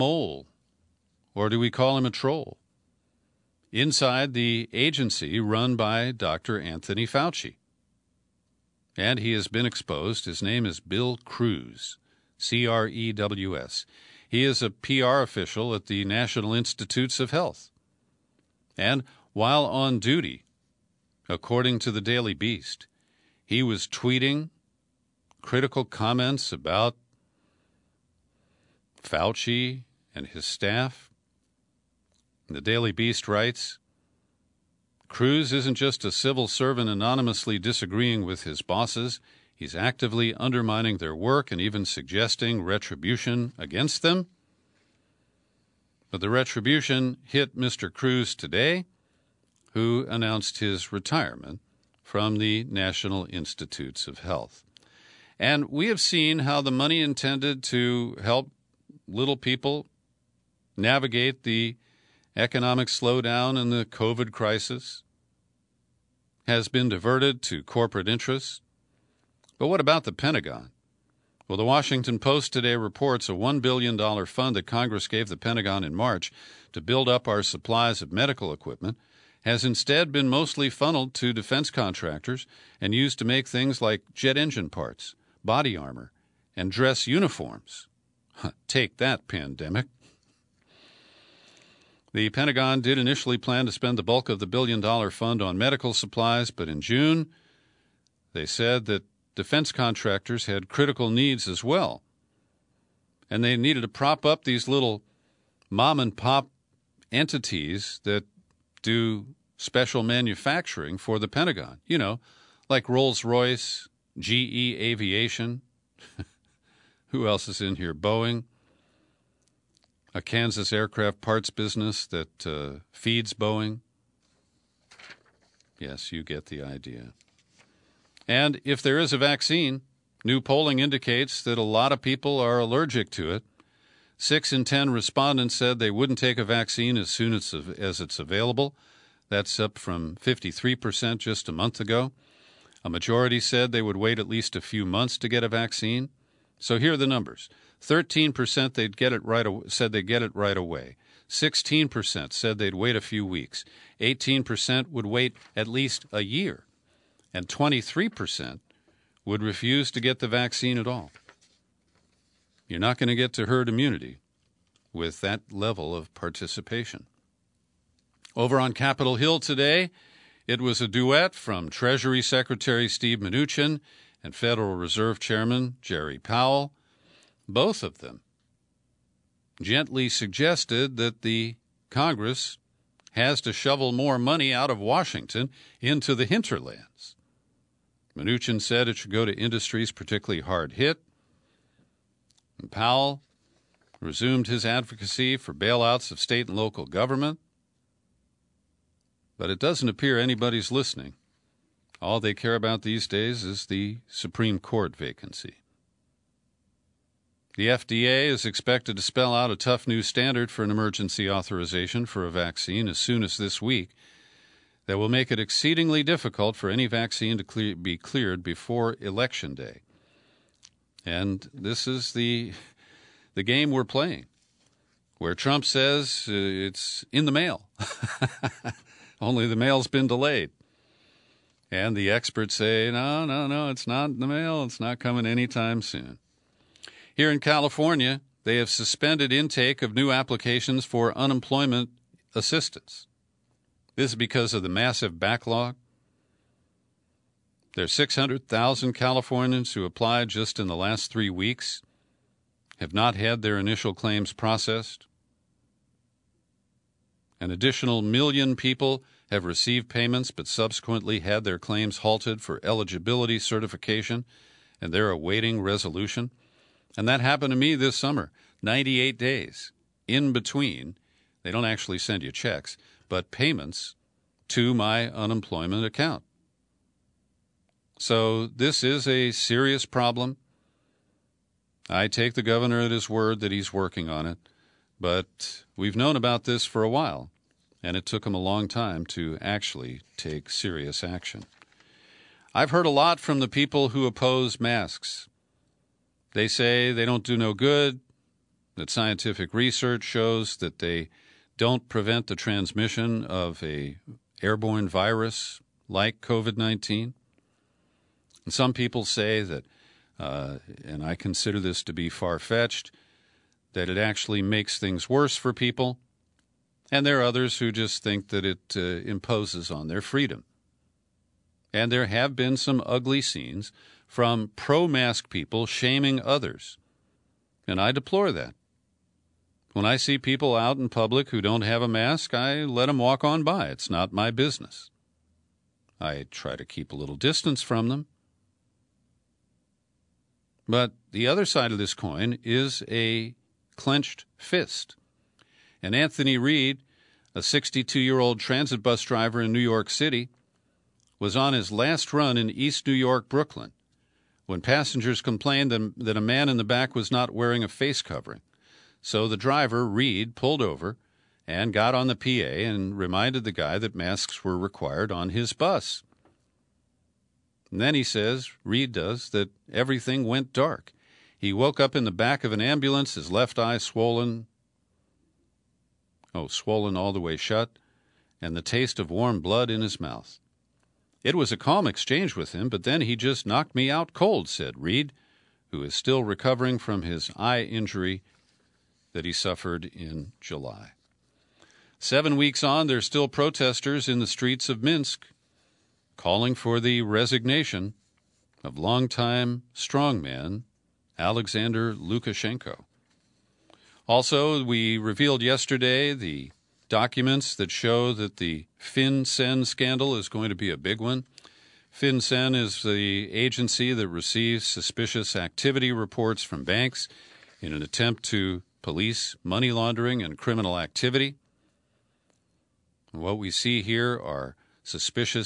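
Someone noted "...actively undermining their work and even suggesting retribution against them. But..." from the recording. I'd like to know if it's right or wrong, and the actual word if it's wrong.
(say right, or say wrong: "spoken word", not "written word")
right.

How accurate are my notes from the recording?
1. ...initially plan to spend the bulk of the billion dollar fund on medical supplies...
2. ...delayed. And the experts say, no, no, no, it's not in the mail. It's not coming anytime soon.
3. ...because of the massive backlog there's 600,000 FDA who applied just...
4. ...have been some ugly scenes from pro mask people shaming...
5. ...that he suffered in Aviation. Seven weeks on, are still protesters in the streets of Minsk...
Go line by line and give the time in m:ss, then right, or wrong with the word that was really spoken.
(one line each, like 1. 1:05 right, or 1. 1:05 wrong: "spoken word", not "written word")
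1. 1:32 right
2. 3:50 right
3. 4:04 wrong: "Californians", not "FDA"
4. 5:22 right
5. 6:29 wrong: "July", not "Aviation".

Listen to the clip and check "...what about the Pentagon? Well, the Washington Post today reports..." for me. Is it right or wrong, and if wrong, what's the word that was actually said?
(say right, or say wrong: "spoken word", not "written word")
right.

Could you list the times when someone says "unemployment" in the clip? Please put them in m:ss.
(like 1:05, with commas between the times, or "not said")
4:01, 4:35.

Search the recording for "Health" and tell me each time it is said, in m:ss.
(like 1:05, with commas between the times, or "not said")
0:17, 0:54.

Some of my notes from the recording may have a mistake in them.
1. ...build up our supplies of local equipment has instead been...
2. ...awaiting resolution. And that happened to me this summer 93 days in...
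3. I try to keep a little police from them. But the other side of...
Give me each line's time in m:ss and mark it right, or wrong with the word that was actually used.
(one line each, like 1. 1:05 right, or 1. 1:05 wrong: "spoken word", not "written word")
1. 1:16 wrong: "medical", not "local"
2. 4:25 wrong: "98", not "93"
3. 5:36 wrong: "distance", not "police".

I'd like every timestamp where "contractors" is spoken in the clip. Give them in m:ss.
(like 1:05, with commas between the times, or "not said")
1:21, 1:39.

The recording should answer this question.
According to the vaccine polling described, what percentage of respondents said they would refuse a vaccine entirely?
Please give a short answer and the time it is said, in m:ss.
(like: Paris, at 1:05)
23%, at 2:37.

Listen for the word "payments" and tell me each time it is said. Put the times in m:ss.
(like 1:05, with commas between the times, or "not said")
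4:19, 4:33.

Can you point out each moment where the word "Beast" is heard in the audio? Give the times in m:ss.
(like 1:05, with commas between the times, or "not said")
0:22, 0:32.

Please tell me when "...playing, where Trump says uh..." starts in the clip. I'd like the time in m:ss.
3:43.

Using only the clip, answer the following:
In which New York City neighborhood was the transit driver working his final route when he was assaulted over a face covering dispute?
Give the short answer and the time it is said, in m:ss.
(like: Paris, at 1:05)
East New York, at 5:52.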